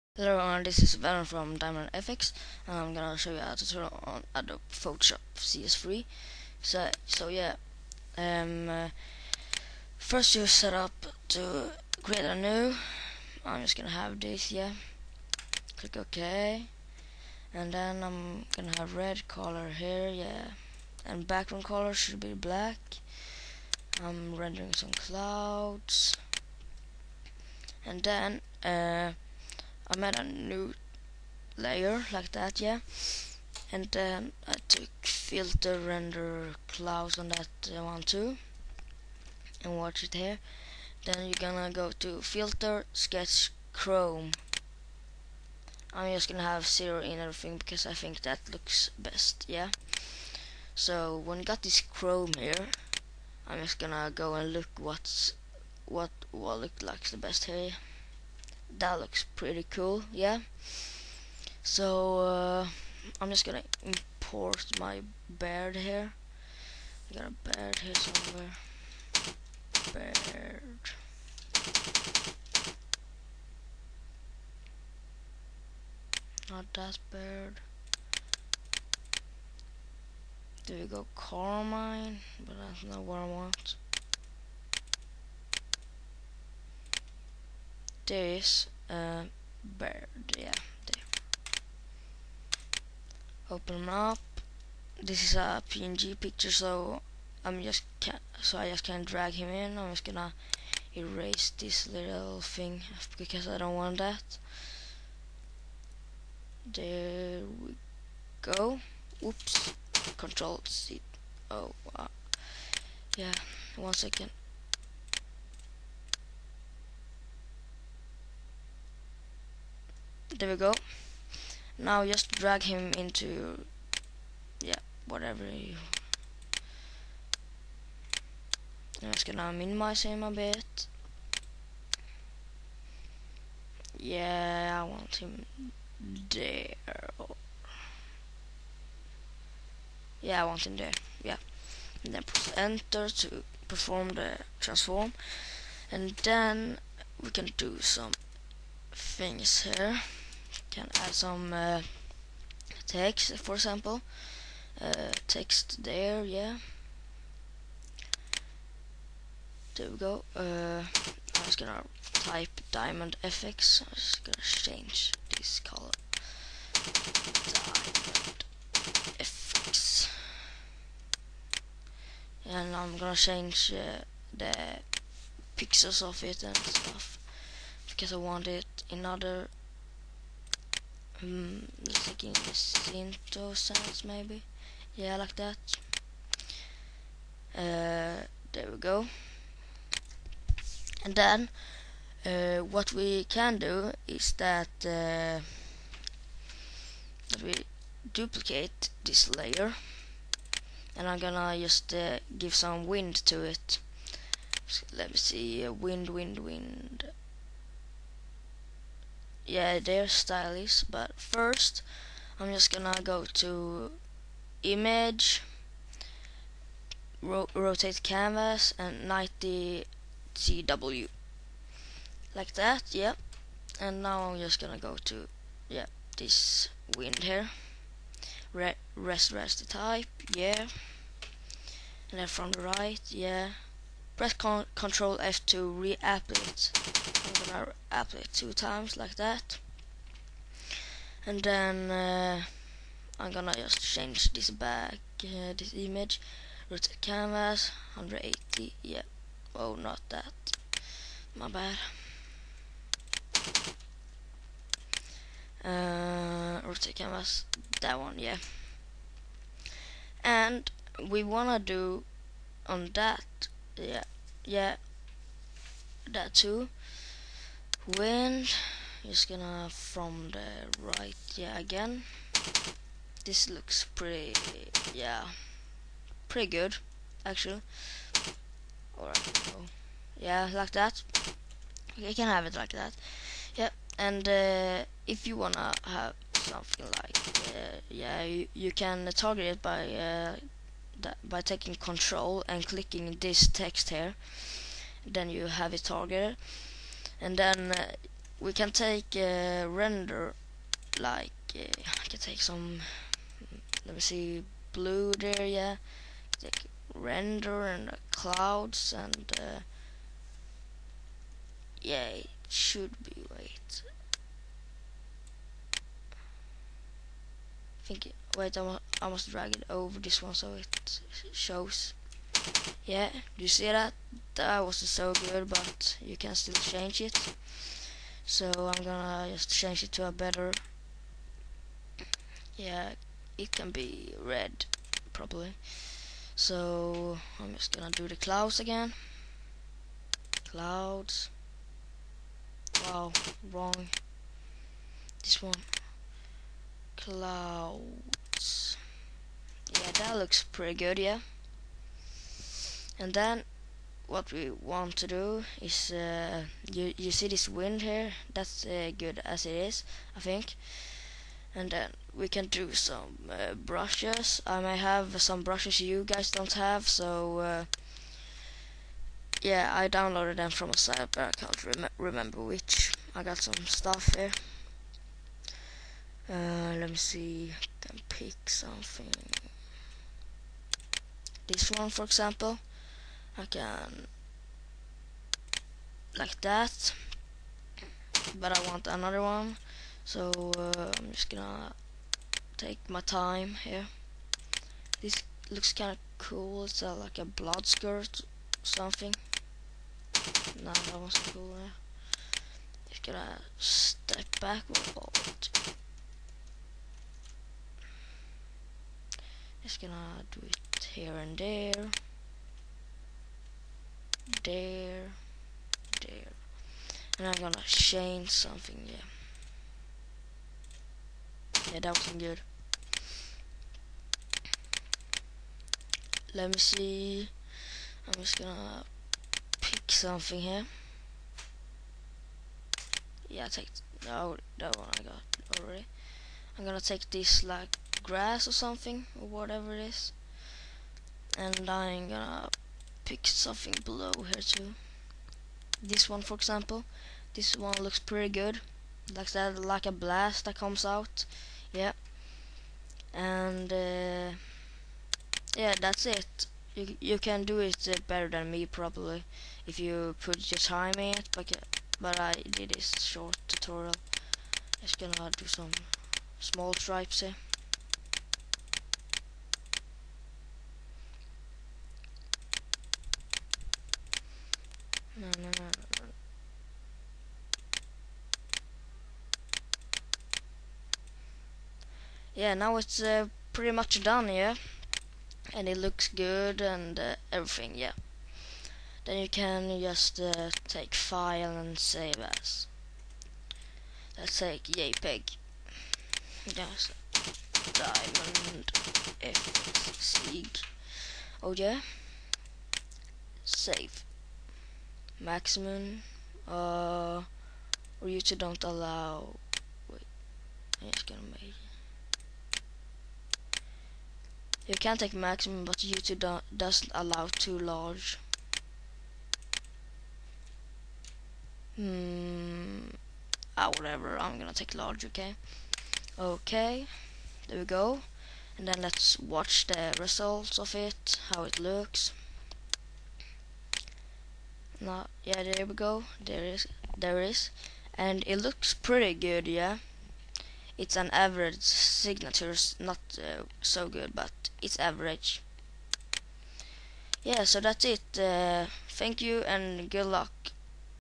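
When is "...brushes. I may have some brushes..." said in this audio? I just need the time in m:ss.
6:03.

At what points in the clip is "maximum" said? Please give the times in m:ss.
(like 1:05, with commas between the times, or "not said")
8:25, 8:35.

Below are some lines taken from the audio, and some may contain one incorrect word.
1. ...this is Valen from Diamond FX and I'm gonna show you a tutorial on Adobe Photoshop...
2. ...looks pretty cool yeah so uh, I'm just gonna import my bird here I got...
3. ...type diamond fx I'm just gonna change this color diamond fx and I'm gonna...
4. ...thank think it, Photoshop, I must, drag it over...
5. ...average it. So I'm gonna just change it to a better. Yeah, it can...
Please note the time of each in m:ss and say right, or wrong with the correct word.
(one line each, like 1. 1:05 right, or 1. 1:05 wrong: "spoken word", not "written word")
1. 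0:00 right
2. 0:58 right
3. 2:42 right
4. 5:17 wrong: "Wait", not "Photoshop"
5. 5:26 wrong: "change", not "average".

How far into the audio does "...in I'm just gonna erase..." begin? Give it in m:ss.
1:39.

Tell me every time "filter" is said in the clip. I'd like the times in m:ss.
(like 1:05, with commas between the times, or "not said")
0:35, 0:42.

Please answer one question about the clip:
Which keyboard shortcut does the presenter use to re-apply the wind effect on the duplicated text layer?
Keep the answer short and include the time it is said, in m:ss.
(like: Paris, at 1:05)
Control F, at 3:54.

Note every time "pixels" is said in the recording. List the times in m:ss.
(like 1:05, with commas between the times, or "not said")
2:55.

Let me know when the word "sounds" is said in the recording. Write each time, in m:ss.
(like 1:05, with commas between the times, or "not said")
3:03.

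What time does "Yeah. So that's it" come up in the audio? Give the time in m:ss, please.
9:07.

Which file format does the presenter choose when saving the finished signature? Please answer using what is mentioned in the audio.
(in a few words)
JPEG.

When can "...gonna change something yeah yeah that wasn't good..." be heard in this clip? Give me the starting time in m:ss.
6:57.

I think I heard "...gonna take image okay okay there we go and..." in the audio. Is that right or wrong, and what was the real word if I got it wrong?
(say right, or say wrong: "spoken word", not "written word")
wrong: "large", not "image".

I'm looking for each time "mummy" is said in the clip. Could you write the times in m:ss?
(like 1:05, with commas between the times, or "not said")
not said.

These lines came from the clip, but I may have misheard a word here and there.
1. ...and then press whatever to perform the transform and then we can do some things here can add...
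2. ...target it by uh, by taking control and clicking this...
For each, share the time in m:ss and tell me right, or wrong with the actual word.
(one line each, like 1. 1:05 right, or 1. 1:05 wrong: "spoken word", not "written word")
1. 2:22 wrong: "enter", not "whatever"
2. 4:49 right.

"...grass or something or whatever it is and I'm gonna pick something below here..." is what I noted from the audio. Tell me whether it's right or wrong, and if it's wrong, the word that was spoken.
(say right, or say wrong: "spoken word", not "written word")
right.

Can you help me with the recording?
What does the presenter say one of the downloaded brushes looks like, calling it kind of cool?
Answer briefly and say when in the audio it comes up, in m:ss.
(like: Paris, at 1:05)
blood skirt, at 6:37.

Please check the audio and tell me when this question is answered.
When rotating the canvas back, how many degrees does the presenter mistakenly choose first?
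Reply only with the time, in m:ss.
4:07.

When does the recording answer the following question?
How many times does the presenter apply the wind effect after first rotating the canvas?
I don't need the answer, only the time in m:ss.
3:58.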